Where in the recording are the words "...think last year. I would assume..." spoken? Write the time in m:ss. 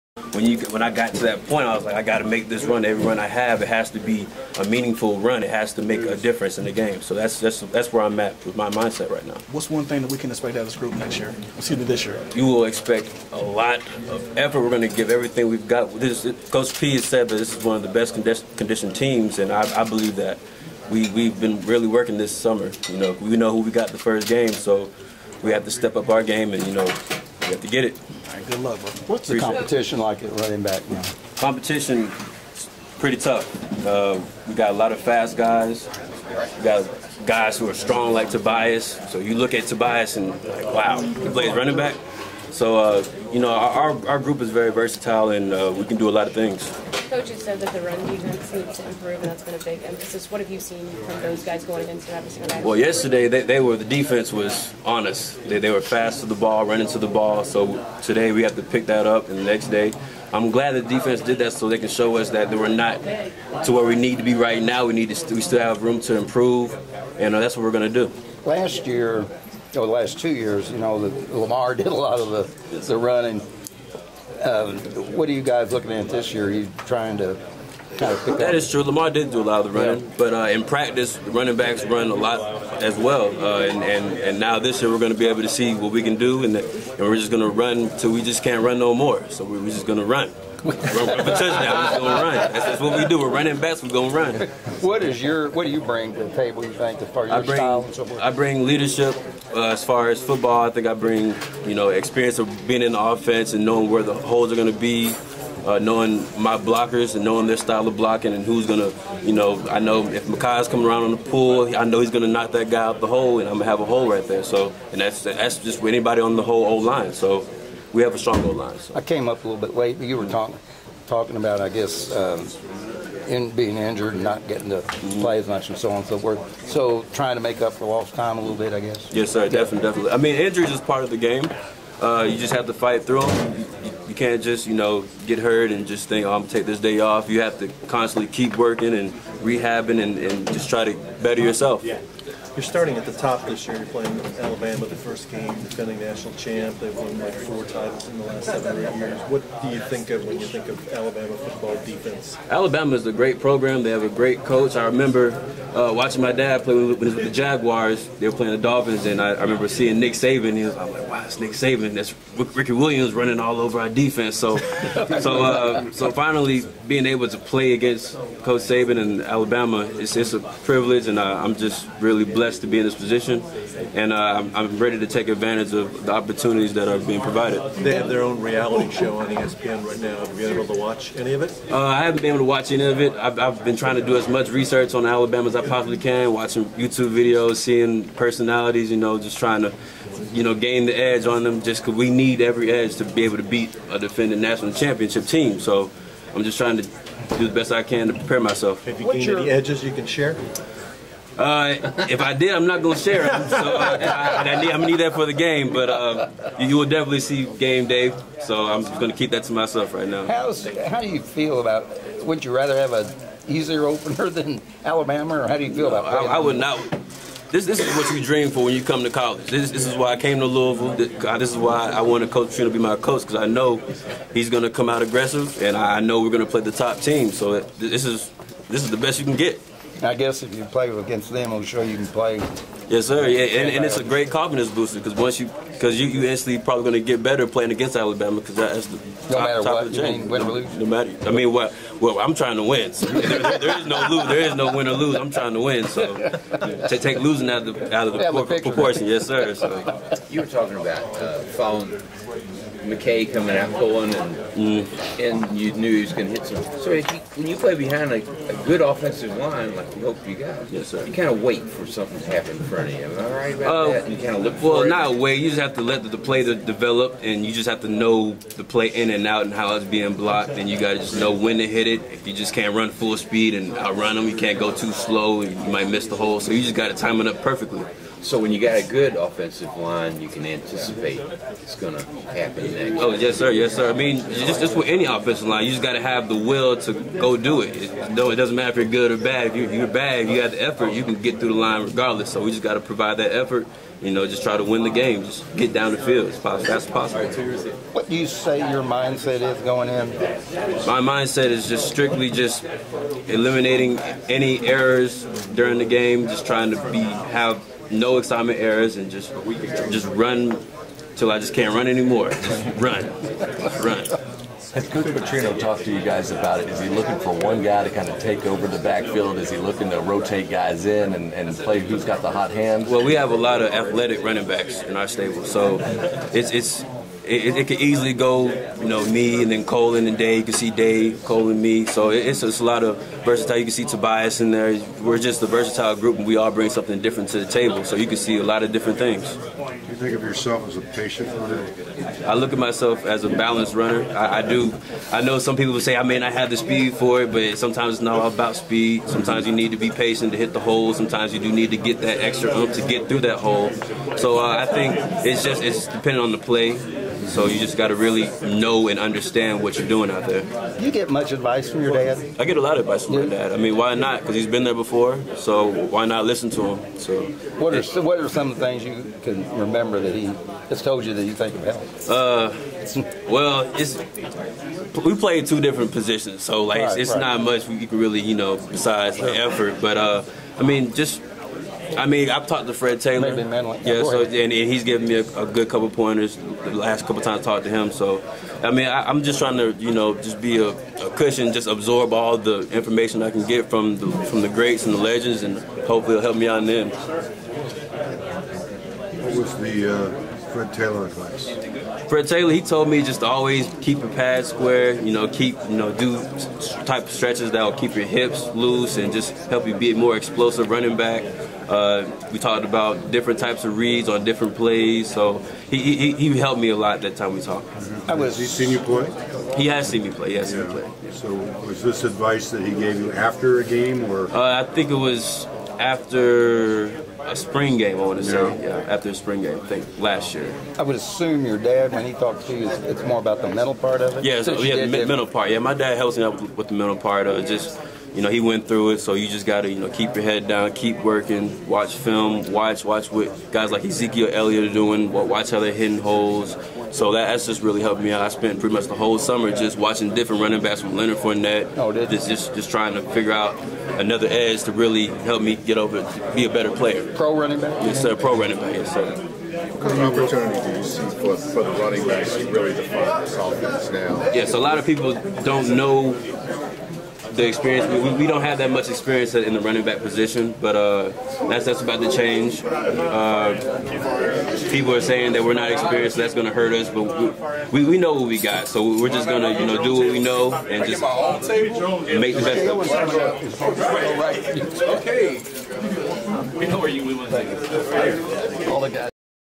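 7:09.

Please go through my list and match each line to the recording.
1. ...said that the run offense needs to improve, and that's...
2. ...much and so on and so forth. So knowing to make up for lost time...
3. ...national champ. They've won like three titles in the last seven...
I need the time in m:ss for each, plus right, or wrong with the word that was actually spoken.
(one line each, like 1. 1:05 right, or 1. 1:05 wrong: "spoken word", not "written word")
1. 0:47 wrong: "defense", not "offense"
2. 2:05 wrong: "trying", not "knowing"
3. 2:25 wrong: "four", not "three".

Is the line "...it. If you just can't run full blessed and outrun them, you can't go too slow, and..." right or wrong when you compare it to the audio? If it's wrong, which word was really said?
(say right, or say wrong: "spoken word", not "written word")
wrong: "speed", not "blessed".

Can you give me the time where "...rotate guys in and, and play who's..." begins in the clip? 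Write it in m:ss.
5:19.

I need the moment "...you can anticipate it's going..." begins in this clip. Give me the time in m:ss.
4:40.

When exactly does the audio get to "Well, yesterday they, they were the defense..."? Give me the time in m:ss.
0:52.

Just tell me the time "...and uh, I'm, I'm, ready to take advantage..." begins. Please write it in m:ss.
2:53.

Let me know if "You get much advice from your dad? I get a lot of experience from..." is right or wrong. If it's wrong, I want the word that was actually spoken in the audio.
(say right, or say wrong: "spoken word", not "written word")
wrong: "advice", not "experience".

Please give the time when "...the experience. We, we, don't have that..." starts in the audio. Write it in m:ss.
7:47.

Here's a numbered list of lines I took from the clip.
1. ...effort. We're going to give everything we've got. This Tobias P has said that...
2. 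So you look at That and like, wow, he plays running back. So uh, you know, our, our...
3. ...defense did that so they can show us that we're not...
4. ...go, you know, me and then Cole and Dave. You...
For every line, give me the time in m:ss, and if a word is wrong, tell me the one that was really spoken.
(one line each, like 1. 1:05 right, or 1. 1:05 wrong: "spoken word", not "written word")
1. 0:14 wrong: "Coach", not "Tobias"
2. 0:39 wrong: "Tobias", not "That"
3. 1:00 right
4. 5:28 right.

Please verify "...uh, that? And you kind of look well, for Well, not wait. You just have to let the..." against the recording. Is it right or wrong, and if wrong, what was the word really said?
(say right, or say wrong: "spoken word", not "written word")
right.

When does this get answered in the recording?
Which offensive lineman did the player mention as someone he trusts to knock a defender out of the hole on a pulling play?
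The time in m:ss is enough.
1:50.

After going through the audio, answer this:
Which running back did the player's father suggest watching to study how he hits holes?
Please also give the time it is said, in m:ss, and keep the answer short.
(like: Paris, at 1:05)
Ezekiel Elliott, at 7:23.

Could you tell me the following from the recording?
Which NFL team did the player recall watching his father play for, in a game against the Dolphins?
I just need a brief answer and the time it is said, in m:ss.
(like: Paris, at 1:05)
Jaguars, at 2:37.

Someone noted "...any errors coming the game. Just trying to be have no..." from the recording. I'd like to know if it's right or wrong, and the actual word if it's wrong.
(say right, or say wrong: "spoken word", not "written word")
wrong: "during", not "coming".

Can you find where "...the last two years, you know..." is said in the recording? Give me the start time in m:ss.
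1:09.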